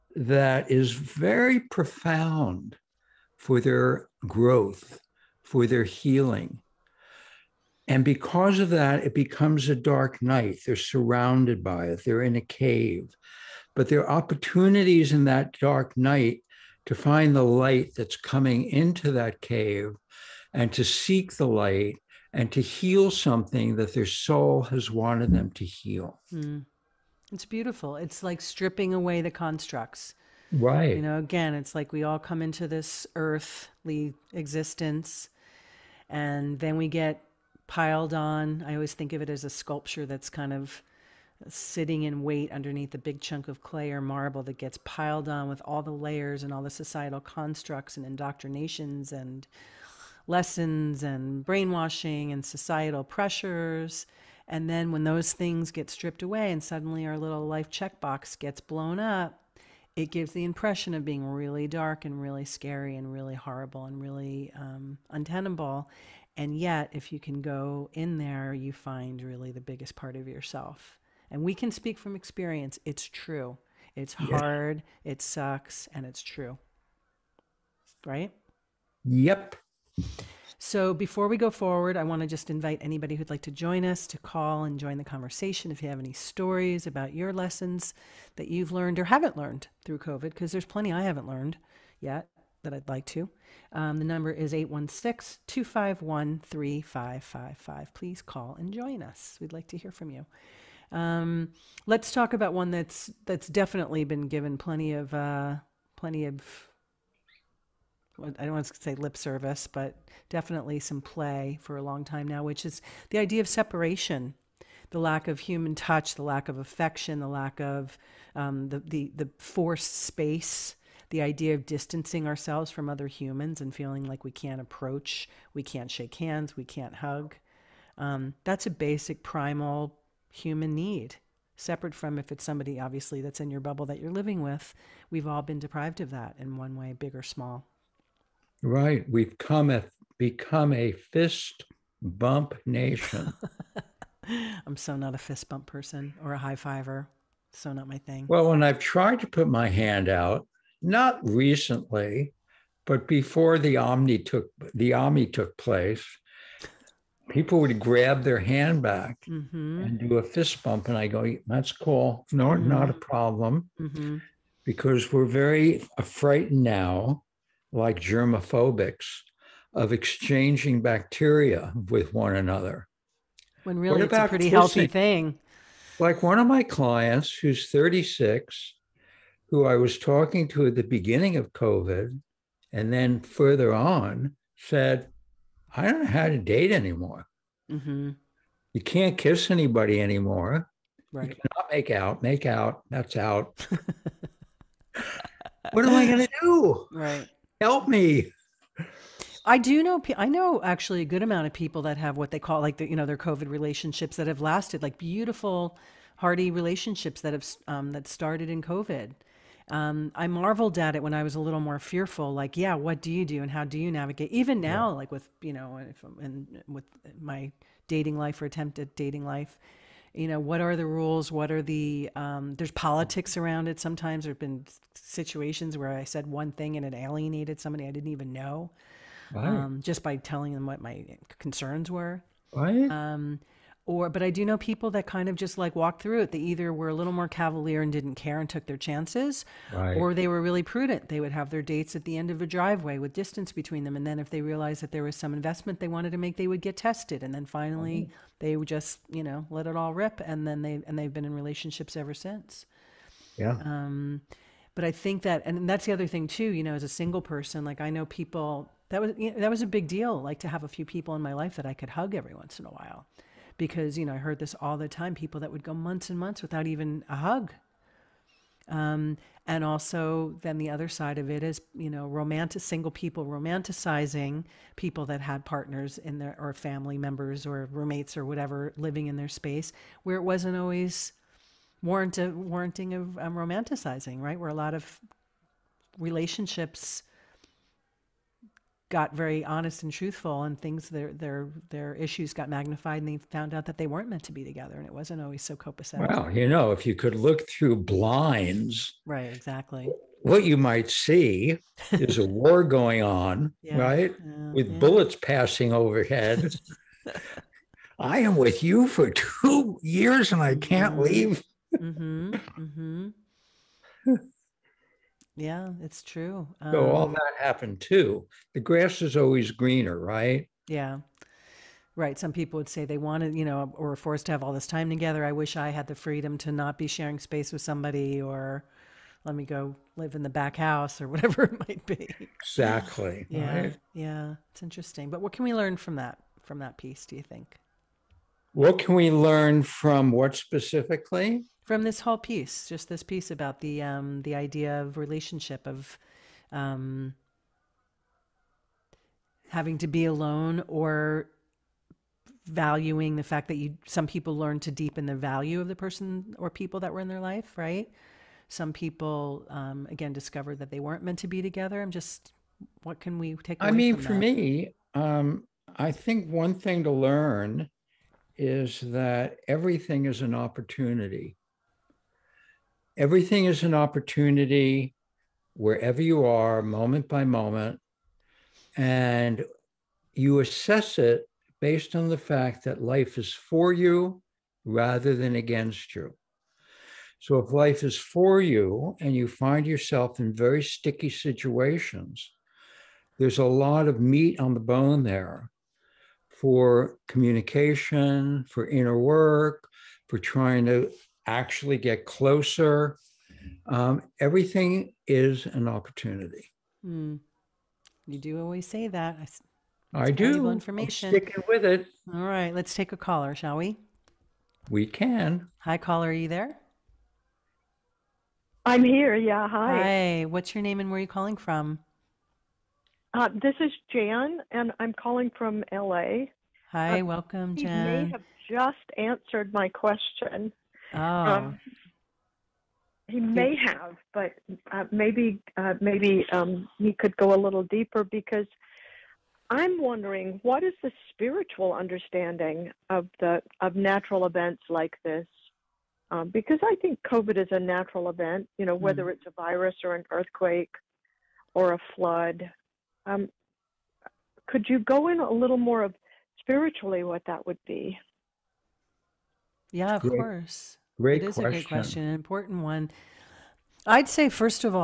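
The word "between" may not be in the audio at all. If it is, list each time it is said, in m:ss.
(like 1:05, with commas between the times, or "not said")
4:03.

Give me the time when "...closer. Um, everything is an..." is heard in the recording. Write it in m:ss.
6:42.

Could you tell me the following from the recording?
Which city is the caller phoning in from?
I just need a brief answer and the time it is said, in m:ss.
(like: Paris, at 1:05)
LA, at 7:05.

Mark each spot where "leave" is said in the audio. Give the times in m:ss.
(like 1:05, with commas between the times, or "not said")
5:11.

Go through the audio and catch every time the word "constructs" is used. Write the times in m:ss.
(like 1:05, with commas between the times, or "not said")
0:29, 0:47.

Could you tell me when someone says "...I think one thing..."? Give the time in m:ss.
6:05.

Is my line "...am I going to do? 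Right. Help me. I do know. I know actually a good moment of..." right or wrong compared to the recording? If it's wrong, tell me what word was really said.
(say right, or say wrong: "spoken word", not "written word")
wrong: "amount", not "moment".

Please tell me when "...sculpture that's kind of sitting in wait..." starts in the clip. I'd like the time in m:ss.
0:39.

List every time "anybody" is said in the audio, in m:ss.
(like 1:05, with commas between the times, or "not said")
1:22, 3:09.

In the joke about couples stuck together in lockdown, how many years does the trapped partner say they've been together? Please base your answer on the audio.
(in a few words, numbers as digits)
2 years.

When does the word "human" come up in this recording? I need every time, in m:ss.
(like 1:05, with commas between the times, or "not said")
1:55, 2:03, 2:10.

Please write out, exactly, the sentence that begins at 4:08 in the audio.
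they would just you know let it all rip, and then they and they've been in relationships ever since.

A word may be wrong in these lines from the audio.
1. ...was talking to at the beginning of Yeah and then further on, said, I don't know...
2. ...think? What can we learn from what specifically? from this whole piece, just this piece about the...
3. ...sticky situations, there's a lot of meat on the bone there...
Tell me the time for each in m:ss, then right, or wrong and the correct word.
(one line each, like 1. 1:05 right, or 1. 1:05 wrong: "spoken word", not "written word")
1. 2:59 wrong: "COVID", not "Yeah"
2. 5:37 right
3. 6:30 right.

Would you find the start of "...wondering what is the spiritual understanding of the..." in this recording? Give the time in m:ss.
7:19.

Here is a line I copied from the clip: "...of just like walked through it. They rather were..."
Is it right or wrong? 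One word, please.
wrong.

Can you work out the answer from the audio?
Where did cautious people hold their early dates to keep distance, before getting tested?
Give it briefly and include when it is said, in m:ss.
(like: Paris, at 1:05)
end of a driveway, at 4:02.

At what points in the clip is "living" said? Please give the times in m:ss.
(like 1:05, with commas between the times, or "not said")
2:14, 4:38.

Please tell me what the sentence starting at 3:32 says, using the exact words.
Like, yeah, what do you do and how do you navigate?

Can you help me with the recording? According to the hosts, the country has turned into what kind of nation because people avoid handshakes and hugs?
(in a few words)
fist bump nation.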